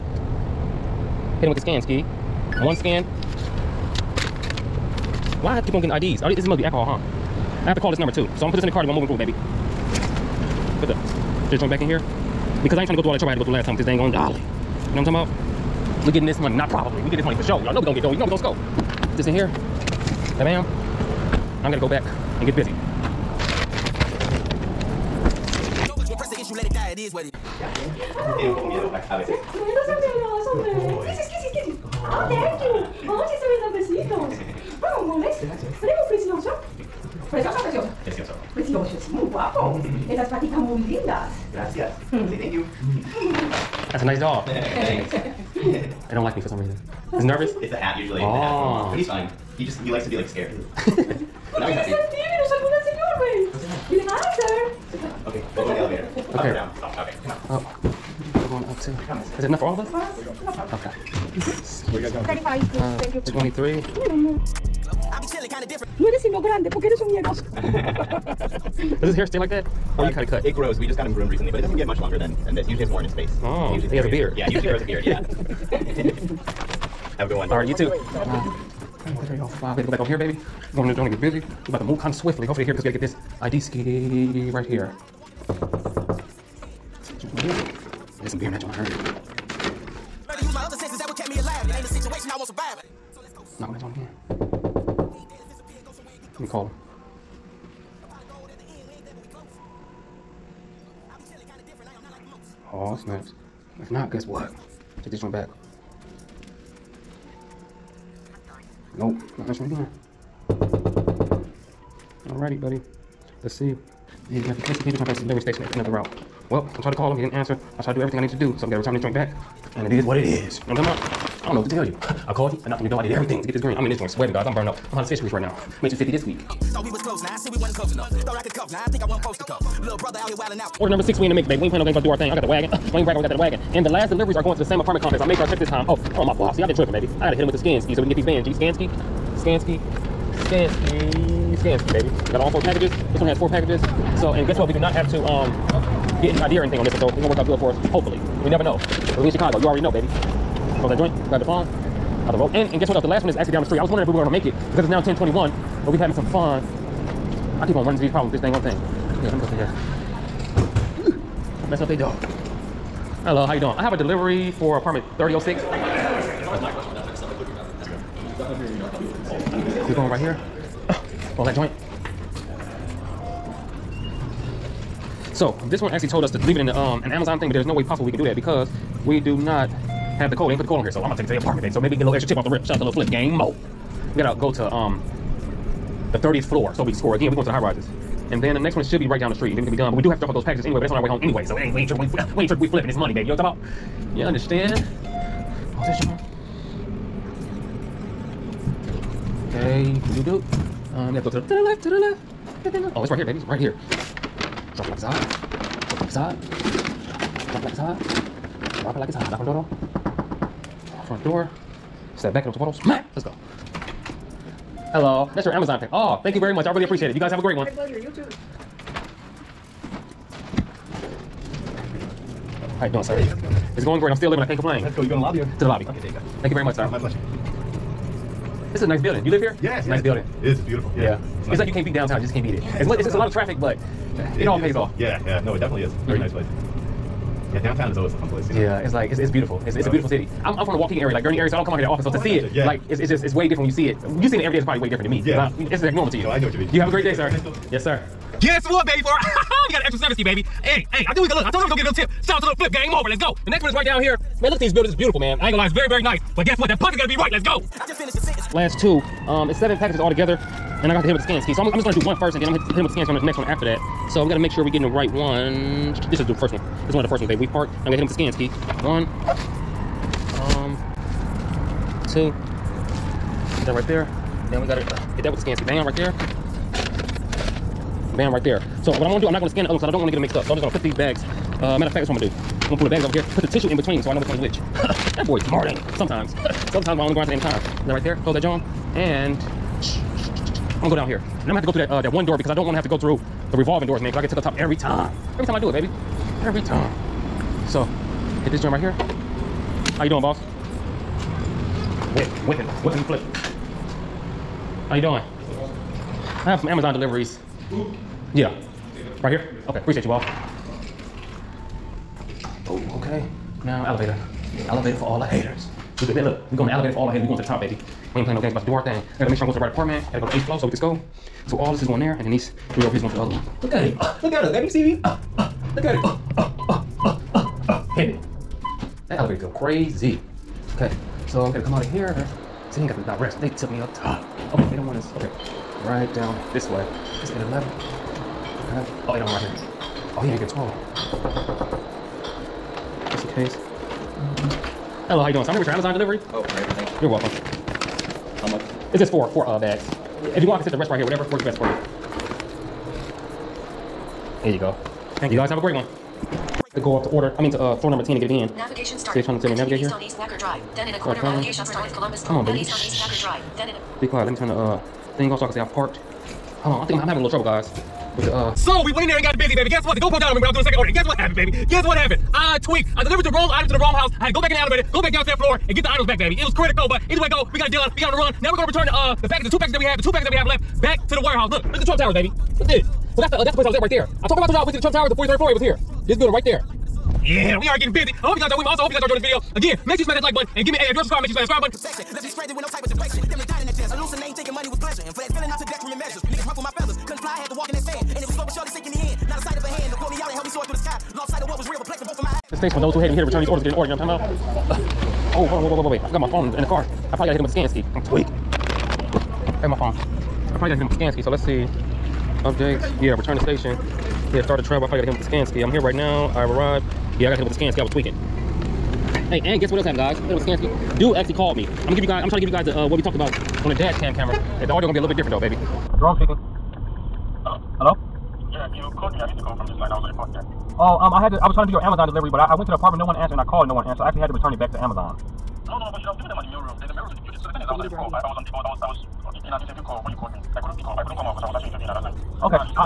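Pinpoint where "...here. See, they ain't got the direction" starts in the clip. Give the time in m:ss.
5:31.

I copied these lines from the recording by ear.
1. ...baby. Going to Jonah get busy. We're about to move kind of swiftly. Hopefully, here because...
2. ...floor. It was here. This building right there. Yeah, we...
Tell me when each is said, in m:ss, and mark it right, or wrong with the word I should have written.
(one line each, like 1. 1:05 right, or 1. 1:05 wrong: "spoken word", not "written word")
1. 1:20 right
2. 6:25 right.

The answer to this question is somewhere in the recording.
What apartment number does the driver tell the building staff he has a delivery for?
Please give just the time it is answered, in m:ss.
2:44.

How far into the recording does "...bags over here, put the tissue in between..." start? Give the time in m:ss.
4:42.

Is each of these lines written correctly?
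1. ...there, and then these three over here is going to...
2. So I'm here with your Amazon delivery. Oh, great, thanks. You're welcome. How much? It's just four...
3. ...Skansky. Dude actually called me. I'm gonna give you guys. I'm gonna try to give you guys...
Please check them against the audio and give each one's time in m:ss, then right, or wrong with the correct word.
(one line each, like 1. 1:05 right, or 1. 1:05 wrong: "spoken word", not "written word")
1. 5:21 right
2. 5:45 right
3. 7:00 right.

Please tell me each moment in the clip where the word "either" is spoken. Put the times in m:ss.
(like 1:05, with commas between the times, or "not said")
6:17.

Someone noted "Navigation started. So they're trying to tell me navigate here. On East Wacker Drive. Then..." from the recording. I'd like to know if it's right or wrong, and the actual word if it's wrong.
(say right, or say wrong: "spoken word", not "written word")
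right.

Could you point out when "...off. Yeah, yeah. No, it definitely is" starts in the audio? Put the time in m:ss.
3:54.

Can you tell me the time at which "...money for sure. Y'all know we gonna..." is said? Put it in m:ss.
0:17.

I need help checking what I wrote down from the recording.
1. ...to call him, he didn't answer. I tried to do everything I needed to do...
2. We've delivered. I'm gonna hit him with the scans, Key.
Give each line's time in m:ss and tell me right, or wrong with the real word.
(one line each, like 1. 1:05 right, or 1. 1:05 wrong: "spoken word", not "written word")
1. 1:56 right
2. 4:27 wrong: "parked", not "delivered".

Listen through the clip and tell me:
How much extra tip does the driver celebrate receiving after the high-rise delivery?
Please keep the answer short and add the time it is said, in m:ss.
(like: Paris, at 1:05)
70, at 4:09.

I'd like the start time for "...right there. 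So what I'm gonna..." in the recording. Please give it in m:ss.
4:38.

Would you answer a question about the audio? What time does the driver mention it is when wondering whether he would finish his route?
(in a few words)
10:21.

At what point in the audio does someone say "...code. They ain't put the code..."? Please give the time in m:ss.
3:00.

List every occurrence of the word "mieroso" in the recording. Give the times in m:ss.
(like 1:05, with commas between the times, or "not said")
1:07.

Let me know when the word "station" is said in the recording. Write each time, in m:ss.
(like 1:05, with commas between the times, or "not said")
1:55, 6:42, 6:53.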